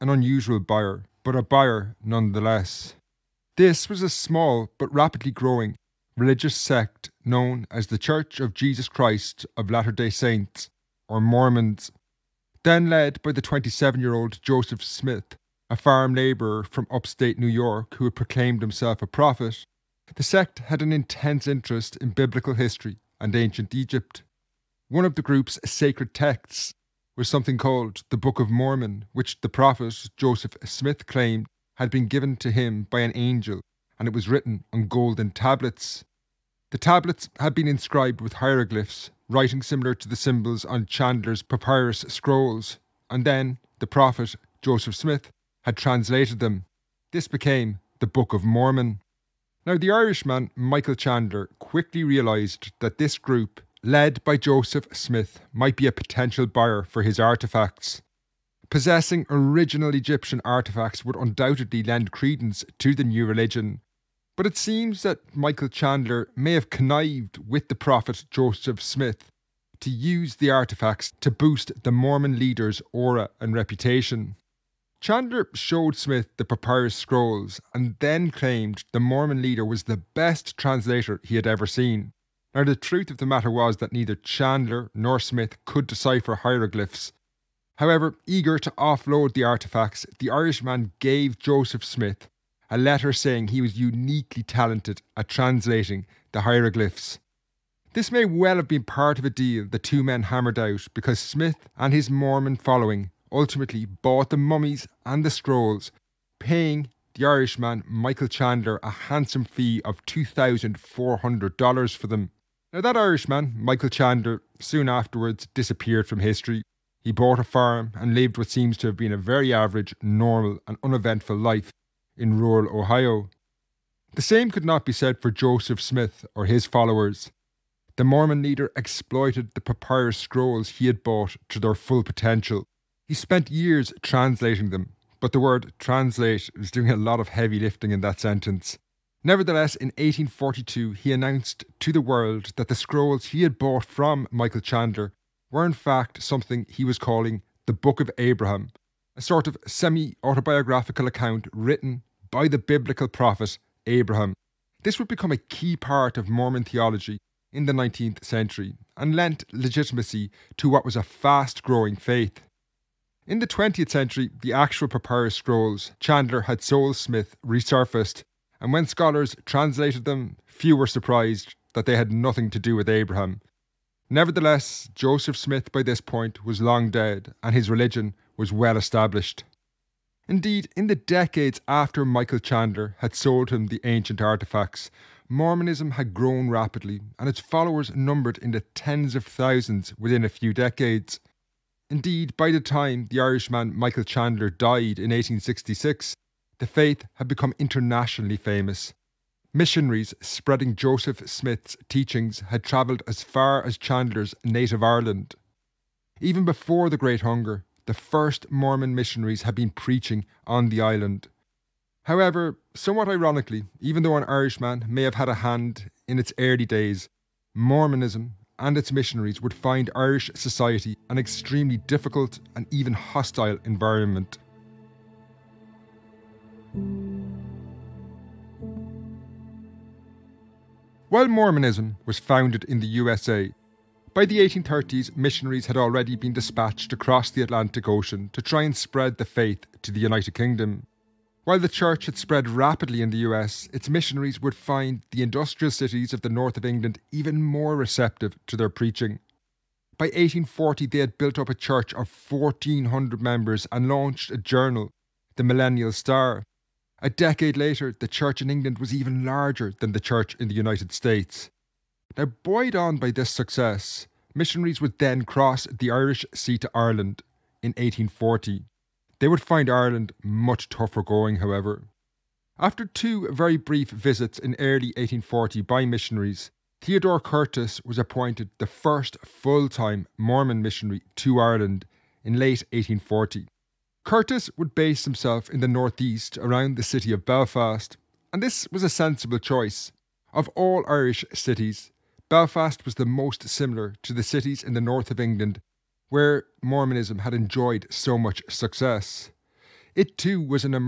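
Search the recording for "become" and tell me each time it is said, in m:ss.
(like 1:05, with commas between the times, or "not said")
2:35, 3:17.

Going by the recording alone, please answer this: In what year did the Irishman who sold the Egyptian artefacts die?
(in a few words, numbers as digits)
1866.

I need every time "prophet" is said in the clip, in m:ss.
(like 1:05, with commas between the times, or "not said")
0:19, 0:29, 0:43, 1:07, 2:33.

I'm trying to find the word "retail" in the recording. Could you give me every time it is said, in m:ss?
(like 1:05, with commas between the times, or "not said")
not said.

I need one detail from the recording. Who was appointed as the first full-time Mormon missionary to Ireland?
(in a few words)
Theodore Curtis.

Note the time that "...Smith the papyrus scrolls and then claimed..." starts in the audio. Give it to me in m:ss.
1:15.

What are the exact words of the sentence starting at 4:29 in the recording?
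They would find Ireland much tougher going, however.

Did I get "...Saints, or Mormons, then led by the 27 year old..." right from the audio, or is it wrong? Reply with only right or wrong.
right.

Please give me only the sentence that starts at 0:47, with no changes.
This became the Book of Mormon.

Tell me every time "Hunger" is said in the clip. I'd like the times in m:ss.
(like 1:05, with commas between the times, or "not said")
3:27.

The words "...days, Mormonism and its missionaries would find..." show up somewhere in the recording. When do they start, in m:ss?
3:36.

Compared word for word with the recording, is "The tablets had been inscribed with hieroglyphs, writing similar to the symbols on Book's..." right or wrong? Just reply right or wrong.
wrong.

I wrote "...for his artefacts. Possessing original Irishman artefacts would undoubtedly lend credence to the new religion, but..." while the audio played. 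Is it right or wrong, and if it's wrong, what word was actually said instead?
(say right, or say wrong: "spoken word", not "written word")
wrong: "Egyptian", not "Irishman".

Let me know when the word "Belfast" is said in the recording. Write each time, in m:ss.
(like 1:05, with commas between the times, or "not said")
4:47, 4:52.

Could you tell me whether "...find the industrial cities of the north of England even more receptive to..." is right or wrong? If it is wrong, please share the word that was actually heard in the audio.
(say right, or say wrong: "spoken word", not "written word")
right.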